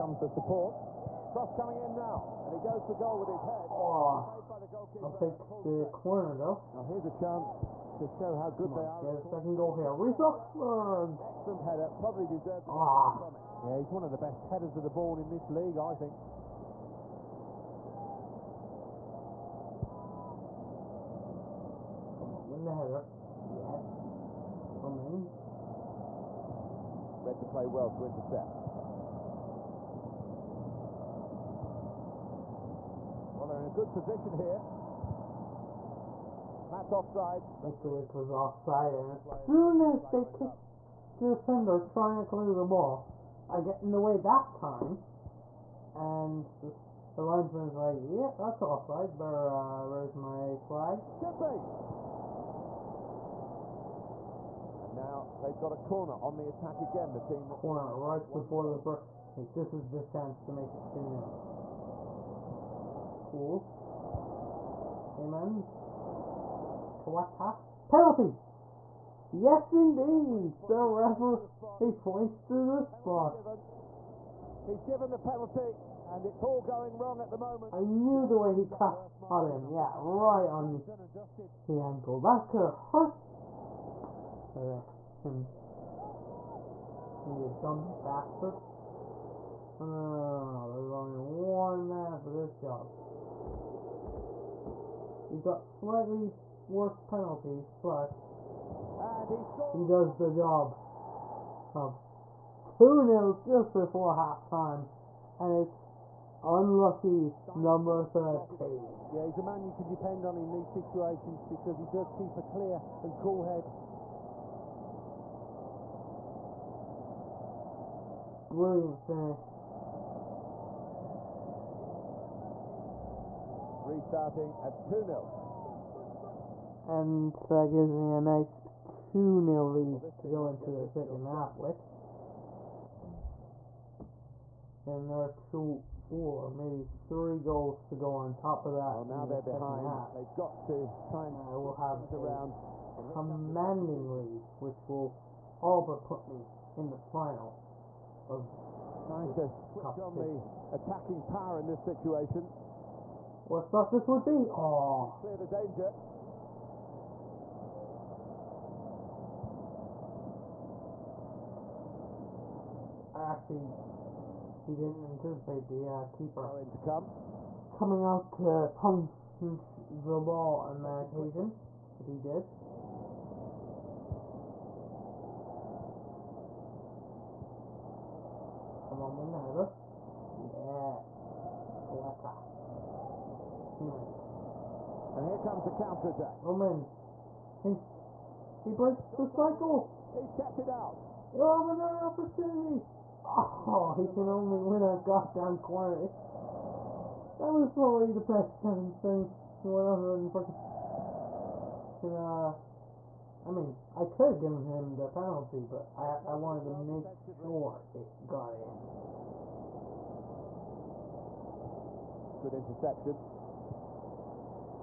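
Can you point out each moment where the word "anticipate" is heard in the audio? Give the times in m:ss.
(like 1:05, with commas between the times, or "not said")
2:45.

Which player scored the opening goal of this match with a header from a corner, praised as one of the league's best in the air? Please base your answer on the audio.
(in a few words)
Reece Oxford.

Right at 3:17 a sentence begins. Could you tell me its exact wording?
That was probably the best chance, and eh?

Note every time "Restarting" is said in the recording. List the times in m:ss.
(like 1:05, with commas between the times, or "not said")
2:03.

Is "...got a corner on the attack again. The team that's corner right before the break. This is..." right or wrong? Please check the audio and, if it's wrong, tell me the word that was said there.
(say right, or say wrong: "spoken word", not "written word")
right.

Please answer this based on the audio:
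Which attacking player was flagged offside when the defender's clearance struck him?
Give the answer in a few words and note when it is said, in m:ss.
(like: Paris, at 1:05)
Nikolic, at 0:37.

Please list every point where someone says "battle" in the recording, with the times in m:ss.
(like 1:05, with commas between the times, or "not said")
not said.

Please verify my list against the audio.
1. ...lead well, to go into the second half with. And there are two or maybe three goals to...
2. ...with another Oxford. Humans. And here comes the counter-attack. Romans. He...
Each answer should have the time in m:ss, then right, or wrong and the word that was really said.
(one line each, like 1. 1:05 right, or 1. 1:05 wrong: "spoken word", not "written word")
1. 2:09 right
2. 2:59 wrong: "Yes", not "Oxford".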